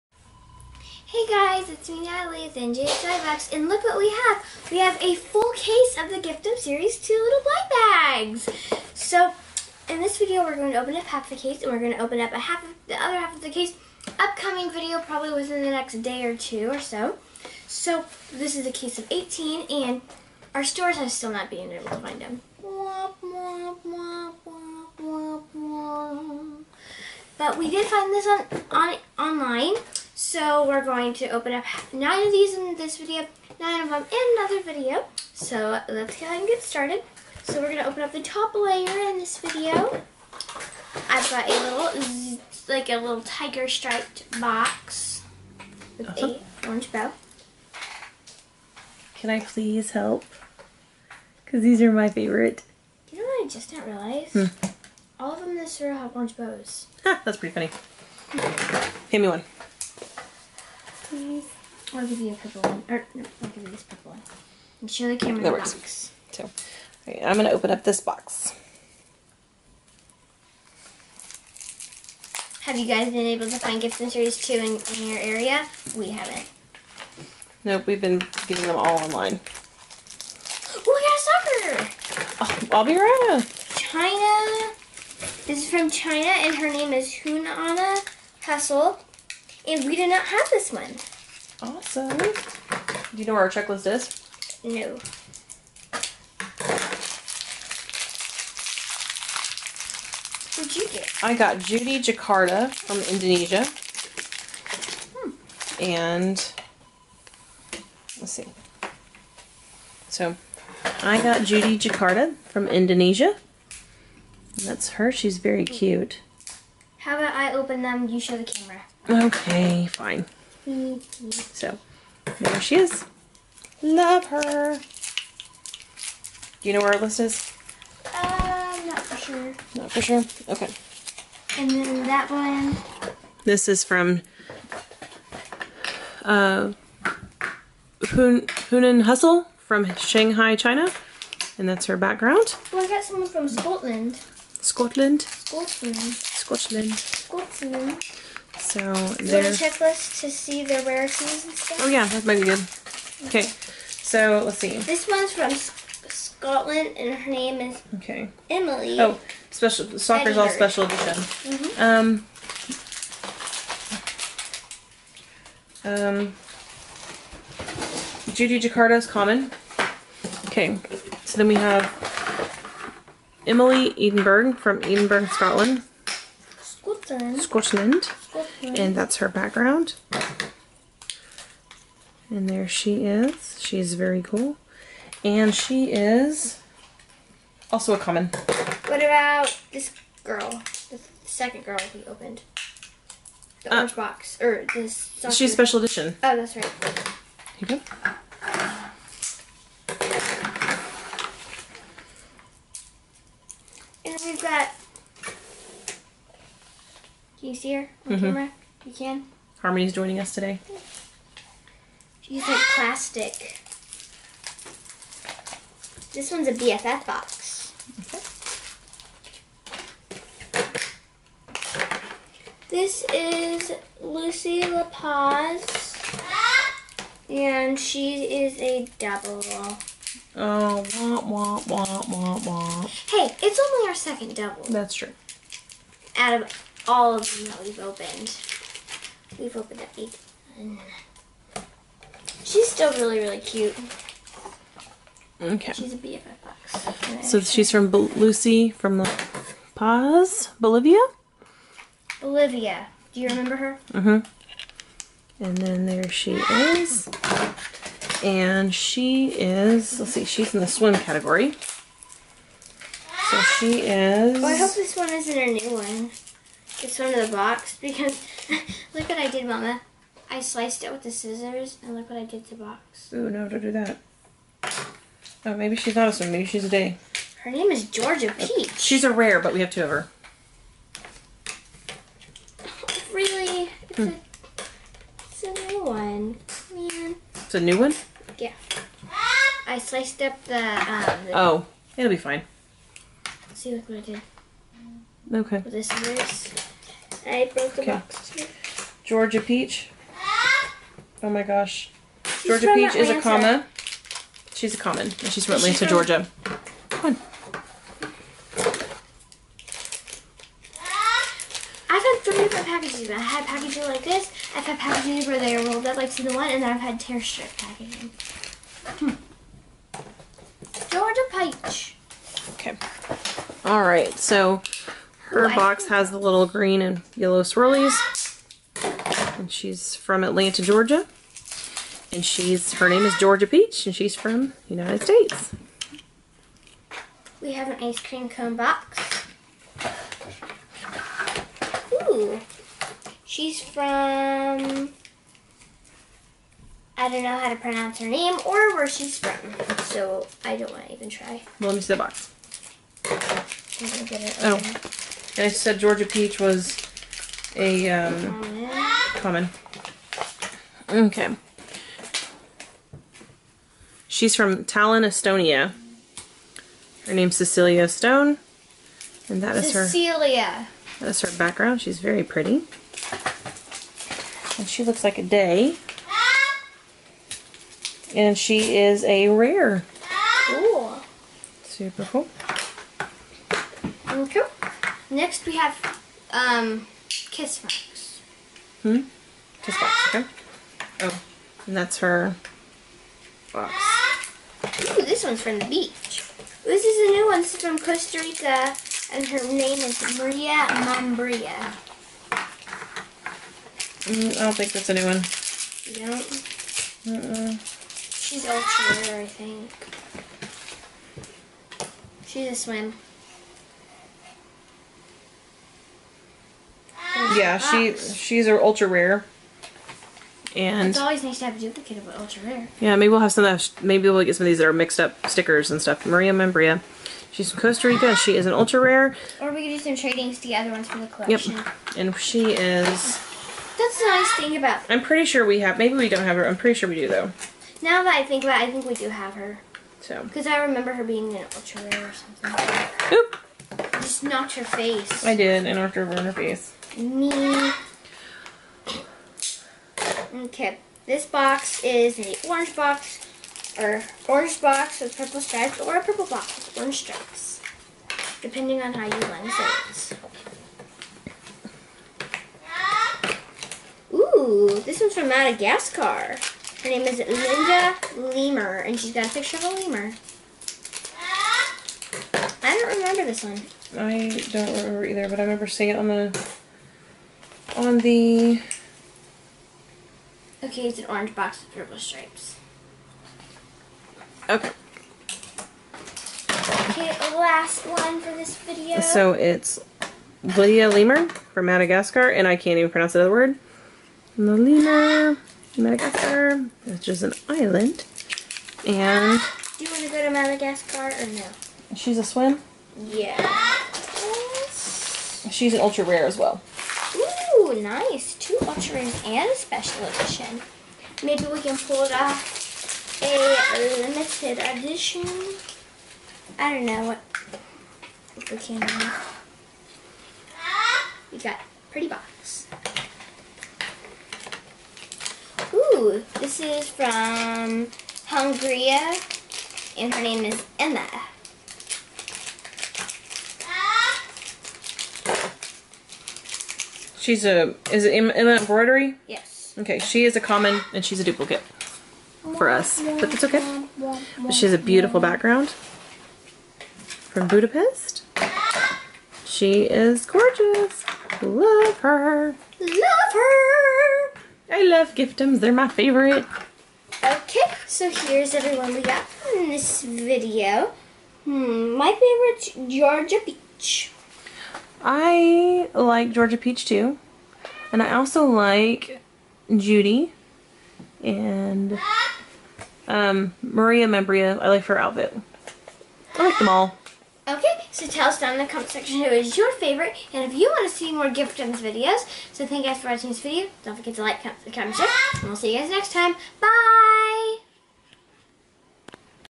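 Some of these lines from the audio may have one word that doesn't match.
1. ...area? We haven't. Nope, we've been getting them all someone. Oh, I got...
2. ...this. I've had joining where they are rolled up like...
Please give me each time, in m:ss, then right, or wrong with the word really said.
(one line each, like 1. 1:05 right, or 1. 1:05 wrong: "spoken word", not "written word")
1. 1:15 wrong: "online", not "someone"
2. 5:14 wrong: "packaging", not "joining".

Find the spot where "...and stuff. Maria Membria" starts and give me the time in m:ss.
7:05.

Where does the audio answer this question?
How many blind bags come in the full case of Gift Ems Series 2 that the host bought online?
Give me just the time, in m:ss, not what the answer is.
0:18.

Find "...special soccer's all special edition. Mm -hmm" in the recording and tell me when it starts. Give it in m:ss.
2:39.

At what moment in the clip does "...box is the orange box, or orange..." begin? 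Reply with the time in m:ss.
7:31.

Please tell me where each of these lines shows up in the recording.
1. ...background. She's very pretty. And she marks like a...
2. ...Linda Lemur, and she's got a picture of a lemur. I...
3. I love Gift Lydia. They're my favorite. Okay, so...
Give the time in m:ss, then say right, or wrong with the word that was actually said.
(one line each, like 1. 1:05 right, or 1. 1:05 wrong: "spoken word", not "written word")
1. 6:11 wrong: "looks", not "marks"
2. 7:47 right
3. 9:14 wrong: "Ems", not "Lydia".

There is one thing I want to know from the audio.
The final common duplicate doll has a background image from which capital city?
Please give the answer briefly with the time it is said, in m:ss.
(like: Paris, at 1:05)
Budapest, at 9:07.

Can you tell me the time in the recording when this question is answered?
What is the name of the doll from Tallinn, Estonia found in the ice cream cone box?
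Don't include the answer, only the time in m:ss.
6:07.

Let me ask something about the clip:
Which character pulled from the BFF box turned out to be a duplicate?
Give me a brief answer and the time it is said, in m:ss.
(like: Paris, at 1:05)
Lucy LaPaz, at 3:43.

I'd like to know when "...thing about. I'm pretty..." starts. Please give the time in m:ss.
7:14.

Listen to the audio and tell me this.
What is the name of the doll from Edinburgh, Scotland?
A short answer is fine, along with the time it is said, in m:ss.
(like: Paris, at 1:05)
Emily Edinburgh, at 2:53.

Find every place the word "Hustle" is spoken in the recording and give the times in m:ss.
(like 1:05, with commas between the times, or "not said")
1:28, 2:19.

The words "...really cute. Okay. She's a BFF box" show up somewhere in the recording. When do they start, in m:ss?
4:03.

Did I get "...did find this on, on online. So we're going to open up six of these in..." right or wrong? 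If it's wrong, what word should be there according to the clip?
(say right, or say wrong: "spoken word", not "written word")
wrong: "nine", not "six".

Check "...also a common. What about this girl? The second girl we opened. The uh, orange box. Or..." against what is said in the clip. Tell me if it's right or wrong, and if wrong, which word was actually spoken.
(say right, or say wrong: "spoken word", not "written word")
right.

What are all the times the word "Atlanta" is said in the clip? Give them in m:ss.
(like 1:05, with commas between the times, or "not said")
5:05, 5:30.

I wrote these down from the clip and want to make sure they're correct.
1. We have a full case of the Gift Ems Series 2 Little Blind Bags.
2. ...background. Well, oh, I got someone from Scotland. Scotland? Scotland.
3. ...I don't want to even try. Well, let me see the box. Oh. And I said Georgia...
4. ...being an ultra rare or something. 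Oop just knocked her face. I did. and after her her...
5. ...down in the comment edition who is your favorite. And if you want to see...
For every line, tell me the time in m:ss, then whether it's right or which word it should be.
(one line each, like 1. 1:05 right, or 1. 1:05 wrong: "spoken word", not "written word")
1. 0:04 right
2. 2:21 right
3. 5:50 right
4. 7:21 right
5. 9:38 wrong: "section", not "edition".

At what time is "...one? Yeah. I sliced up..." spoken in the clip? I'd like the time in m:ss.
4:47.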